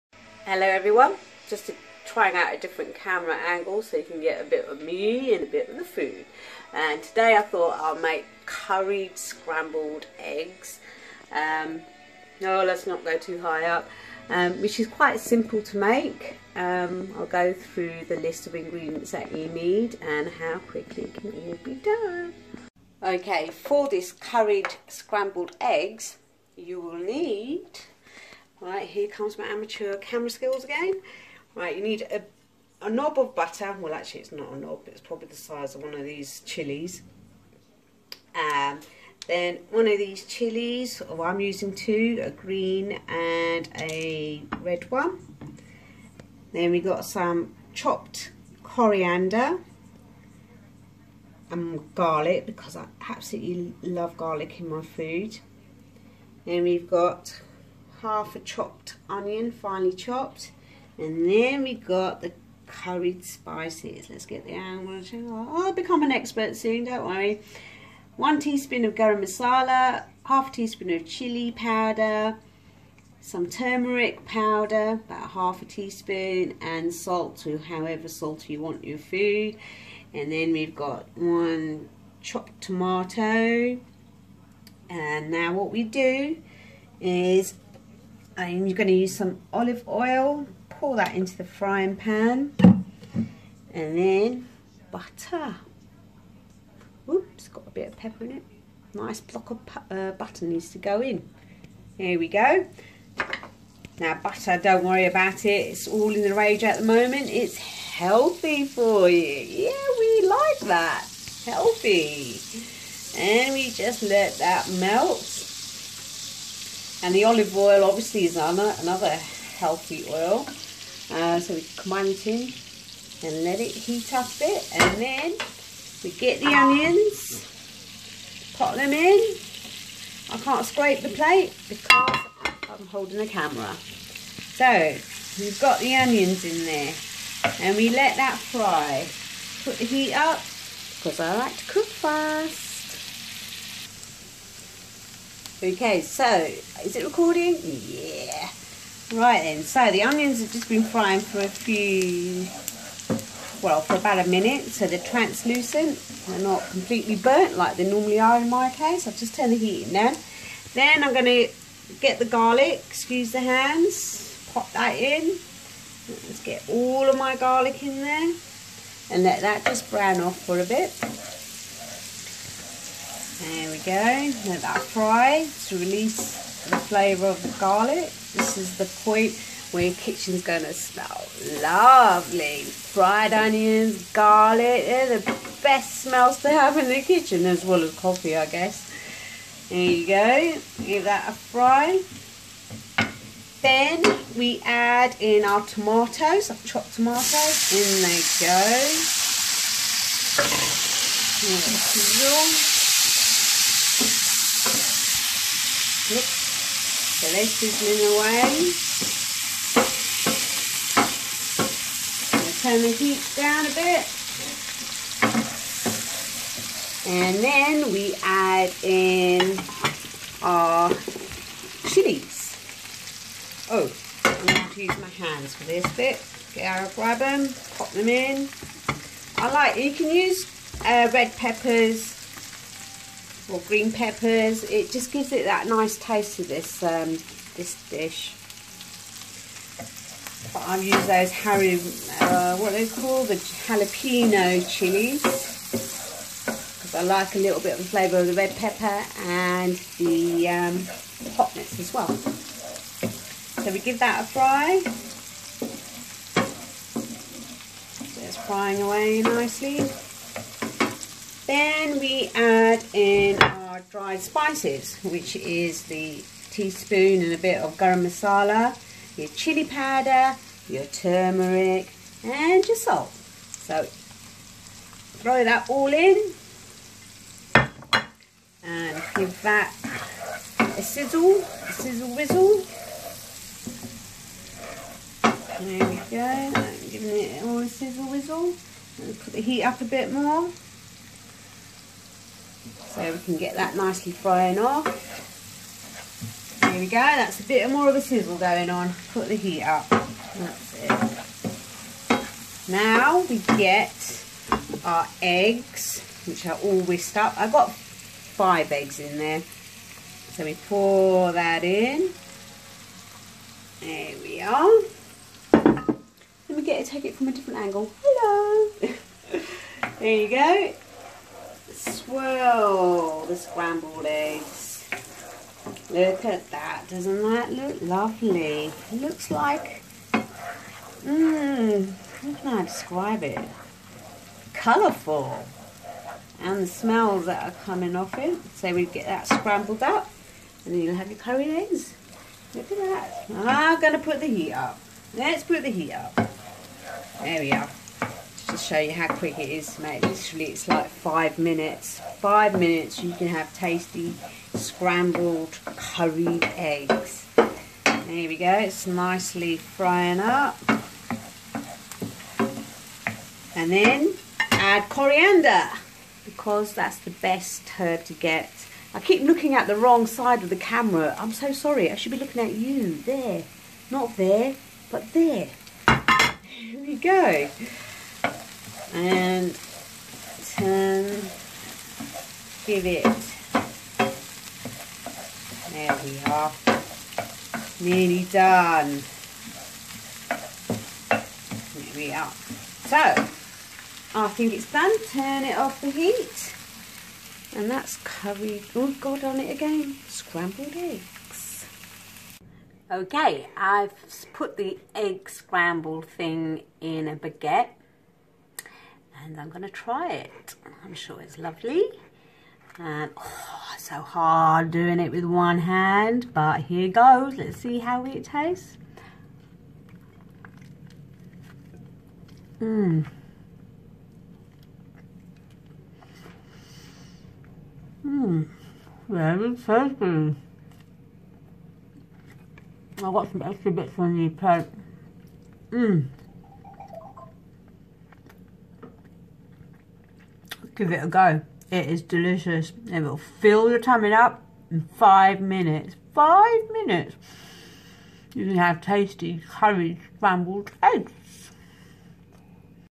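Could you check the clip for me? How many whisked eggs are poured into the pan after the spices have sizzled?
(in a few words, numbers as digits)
5.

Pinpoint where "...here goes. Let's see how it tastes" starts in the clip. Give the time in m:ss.
6:56.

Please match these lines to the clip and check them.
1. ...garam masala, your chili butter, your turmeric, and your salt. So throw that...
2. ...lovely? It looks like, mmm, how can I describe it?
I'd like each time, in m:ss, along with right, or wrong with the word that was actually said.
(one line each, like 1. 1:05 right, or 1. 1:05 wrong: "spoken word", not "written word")
1. 4:27 wrong: "powder", not "butter"
2. 5:27 right.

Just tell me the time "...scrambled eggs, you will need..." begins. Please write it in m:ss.
0:24.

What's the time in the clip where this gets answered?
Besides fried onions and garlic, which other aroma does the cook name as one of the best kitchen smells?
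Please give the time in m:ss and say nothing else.
3:07.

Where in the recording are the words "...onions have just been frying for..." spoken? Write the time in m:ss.
2:30.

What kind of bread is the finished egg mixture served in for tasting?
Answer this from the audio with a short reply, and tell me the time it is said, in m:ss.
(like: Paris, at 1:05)
Baguette, at 6:47.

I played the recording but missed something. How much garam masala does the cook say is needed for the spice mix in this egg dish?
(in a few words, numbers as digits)
1 teaspoon.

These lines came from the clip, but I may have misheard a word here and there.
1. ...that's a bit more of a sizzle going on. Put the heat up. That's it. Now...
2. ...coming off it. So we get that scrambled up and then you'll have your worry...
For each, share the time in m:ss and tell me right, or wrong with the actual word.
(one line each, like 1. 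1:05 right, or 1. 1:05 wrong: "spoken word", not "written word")
1. 4:56 right
2. 5:37 wrong: "curry", not "worry".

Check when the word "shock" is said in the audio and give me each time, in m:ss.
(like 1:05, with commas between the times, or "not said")
not said.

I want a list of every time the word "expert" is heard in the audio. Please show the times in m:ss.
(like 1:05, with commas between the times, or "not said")
1:06.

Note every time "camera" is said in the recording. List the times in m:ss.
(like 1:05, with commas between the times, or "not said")
0:02, 0:29, 2:13, 6:10.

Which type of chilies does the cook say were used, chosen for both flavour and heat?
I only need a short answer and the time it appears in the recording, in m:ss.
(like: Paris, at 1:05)
Jalapeno, at 4:03.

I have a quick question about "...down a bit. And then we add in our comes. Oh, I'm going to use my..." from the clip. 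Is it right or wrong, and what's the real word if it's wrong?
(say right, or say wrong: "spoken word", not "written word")
wrong: "chilies", not "comes".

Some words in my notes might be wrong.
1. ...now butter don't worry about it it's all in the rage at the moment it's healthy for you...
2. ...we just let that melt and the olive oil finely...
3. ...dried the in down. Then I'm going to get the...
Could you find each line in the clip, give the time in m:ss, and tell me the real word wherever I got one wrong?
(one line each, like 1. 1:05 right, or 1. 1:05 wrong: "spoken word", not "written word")
1. 1:43 right
2. 1:53 wrong: "obviously", not "finely"
3. 2:39 wrong: "turned", not "dried".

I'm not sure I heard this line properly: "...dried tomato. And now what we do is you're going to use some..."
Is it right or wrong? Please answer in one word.
wrong.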